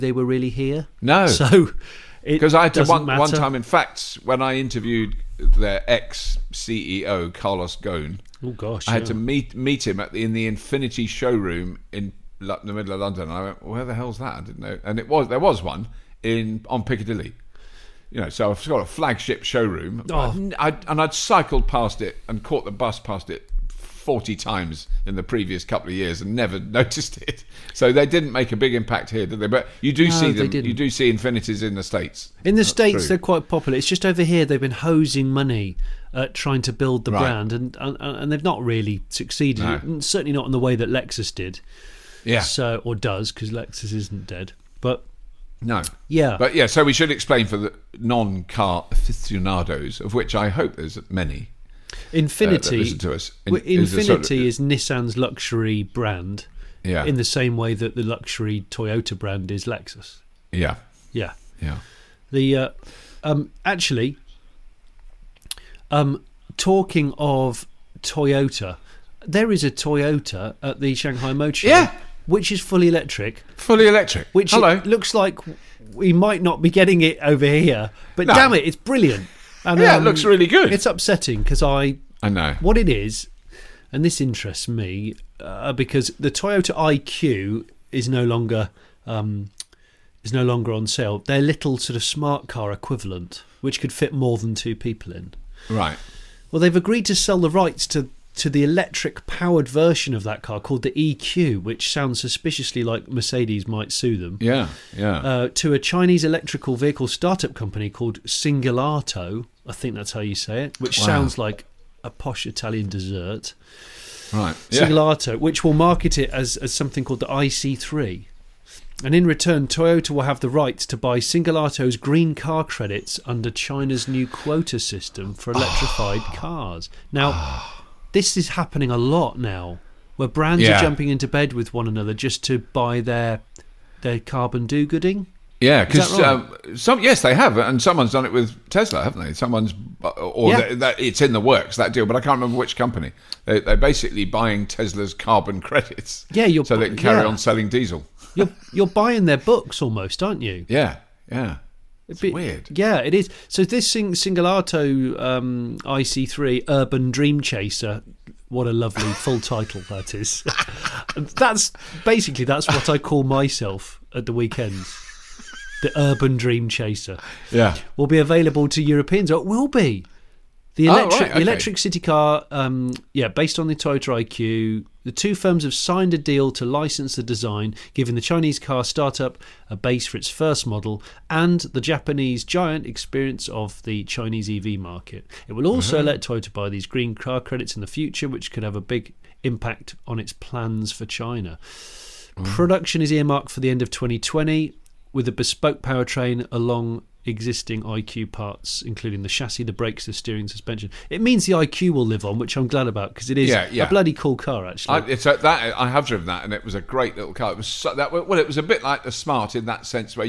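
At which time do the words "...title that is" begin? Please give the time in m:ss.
2:39.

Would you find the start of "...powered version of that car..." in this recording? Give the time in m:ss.
1:39.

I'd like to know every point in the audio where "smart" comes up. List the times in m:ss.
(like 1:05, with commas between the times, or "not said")
1:32, 3:29.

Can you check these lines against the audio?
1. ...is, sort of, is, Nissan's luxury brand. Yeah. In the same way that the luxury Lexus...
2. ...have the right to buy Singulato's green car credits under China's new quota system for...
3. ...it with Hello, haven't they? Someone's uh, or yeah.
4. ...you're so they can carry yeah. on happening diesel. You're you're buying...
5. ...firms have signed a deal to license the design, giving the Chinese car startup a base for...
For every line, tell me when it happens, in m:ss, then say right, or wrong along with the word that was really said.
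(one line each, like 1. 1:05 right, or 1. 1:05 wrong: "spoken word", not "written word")
1. 0:53 wrong: "Toyota", not "Lexus"
2. 2:00 right
3. 2:18 wrong: "Tesla", not "Hello"
4. 2:26 wrong: "selling", not "happening"
5. 2:55 right.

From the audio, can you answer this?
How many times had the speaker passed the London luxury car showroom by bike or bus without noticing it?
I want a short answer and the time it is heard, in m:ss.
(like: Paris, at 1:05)
40, at 0:23.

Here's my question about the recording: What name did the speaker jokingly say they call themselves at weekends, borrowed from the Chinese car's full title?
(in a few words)
The Urban Dream Chaser.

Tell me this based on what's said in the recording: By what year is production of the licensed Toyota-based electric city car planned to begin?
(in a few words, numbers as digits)
2020.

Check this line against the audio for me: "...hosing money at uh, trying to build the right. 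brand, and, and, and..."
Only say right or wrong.
right.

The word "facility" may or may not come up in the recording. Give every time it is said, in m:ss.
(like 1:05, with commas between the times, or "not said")
not said.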